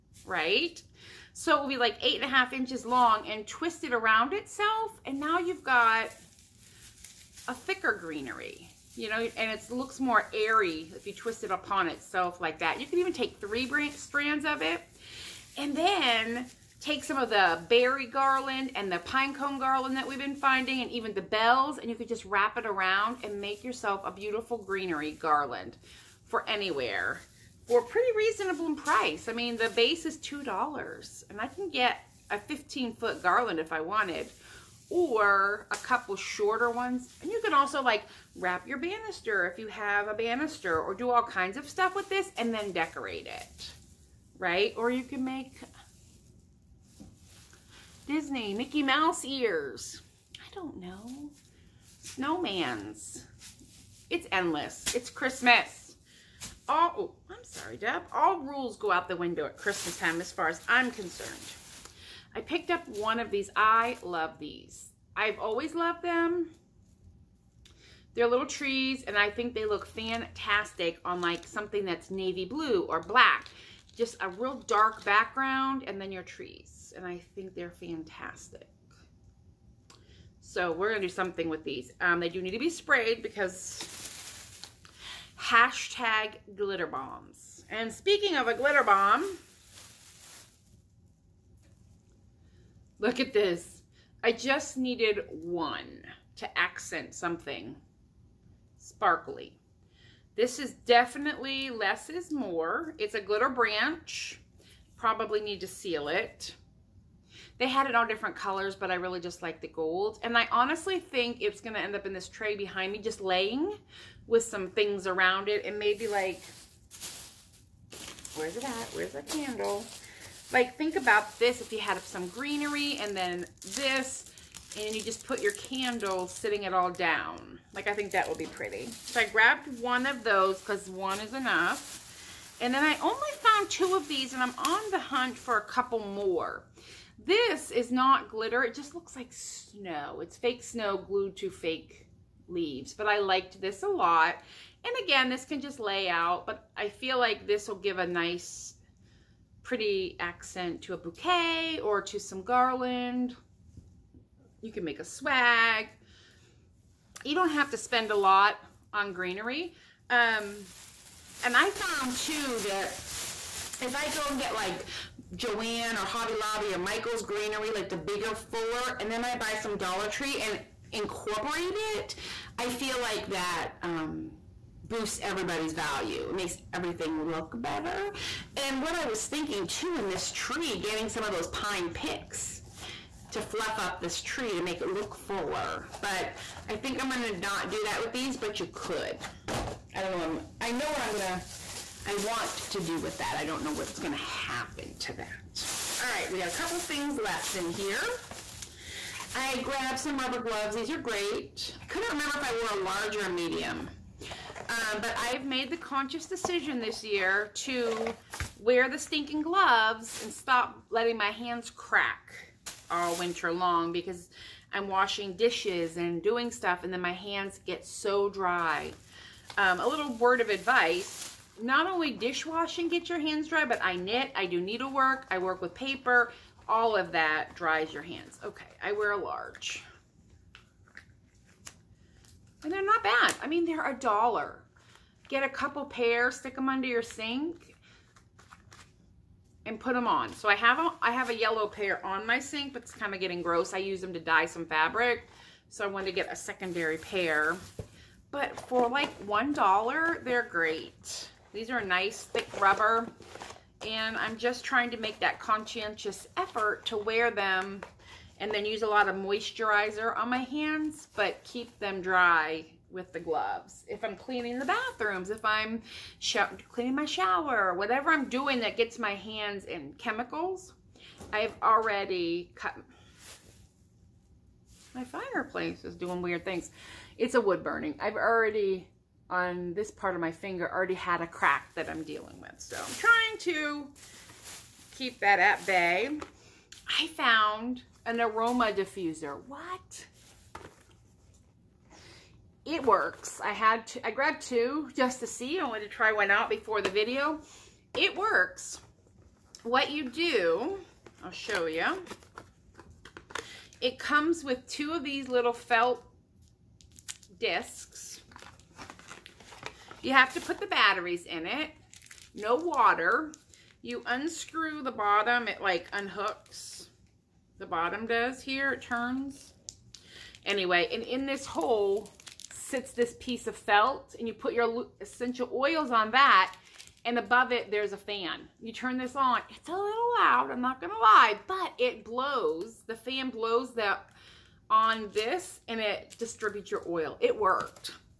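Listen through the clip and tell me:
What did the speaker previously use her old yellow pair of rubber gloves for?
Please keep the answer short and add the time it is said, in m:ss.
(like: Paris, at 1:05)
dye some fabric, at 4:04.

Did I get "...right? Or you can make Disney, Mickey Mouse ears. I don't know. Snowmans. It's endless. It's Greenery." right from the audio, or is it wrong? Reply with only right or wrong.
wrong.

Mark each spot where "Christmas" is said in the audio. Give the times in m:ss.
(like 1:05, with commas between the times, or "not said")
0:55, 0:59.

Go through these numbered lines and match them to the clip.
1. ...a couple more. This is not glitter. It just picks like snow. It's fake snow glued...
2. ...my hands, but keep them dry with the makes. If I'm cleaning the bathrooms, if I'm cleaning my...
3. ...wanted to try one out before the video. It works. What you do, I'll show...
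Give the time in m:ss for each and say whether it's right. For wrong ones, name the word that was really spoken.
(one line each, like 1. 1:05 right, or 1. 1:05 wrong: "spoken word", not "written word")
1. 2:15 wrong: "looks", not "picks"
2. 4:20 wrong: "gloves", not "makes"
3. 4:55 right.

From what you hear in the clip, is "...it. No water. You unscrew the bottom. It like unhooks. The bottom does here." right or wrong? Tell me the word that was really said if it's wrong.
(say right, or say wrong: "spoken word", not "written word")
right.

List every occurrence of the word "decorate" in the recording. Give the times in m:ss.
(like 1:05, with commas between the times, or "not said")
0:42.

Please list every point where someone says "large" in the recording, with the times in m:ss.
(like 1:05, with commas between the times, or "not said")
3:22, 3:49.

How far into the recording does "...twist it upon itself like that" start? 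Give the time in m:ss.
0:11.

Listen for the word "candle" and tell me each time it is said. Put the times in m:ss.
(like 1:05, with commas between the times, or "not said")
1:59, 2:05.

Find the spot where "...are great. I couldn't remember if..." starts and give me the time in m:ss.
3:20.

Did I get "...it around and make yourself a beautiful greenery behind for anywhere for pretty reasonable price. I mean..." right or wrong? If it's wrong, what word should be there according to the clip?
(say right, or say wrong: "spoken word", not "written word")
wrong: "garland", not "behind".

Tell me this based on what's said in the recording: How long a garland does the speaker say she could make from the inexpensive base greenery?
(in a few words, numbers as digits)
15 foot.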